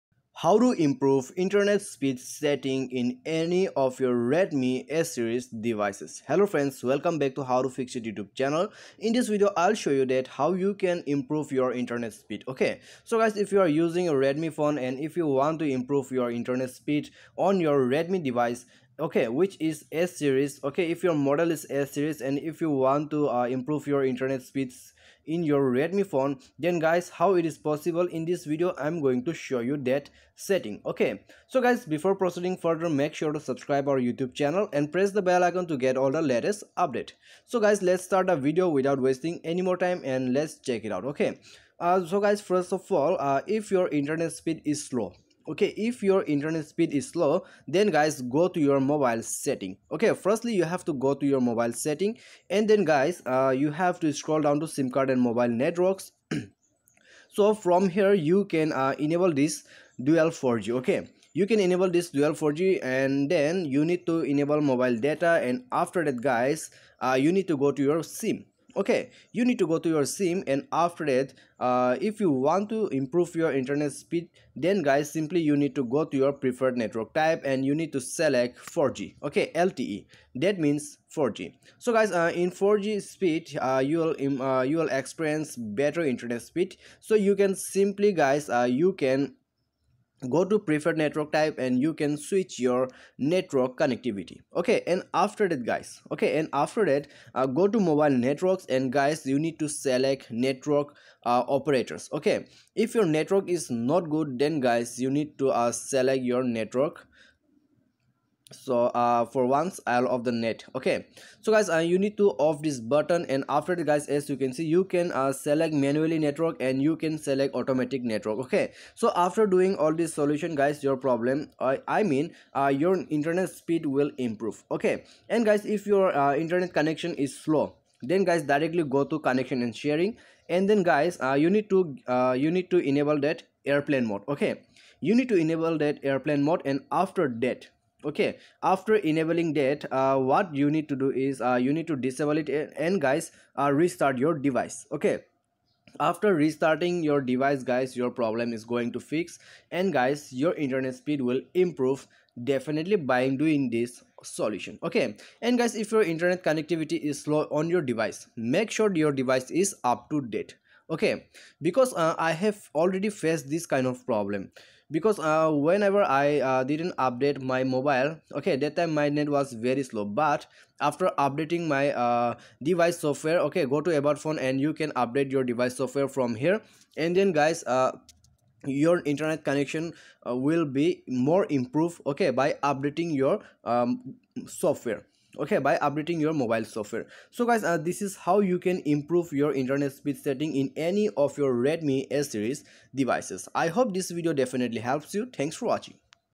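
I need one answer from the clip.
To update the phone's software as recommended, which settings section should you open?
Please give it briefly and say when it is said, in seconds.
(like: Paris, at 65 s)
About phone, at 174 s.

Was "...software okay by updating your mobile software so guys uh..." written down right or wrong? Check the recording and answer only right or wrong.
right.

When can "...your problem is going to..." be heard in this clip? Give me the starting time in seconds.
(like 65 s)
147 s.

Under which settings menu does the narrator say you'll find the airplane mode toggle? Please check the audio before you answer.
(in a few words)
Connection and sharing.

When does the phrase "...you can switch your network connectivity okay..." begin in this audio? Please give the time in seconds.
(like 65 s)
91 s.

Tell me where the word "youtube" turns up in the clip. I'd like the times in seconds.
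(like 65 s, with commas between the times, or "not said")
8 s, 33 s.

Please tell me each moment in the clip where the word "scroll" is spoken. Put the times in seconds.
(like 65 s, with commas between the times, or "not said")
54 s.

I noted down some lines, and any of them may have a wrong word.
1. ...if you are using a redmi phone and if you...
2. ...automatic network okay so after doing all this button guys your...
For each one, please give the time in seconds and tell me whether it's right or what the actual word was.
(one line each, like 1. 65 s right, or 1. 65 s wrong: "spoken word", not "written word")
1. 13 s right
2. 117 s wrong: "solution", not "button".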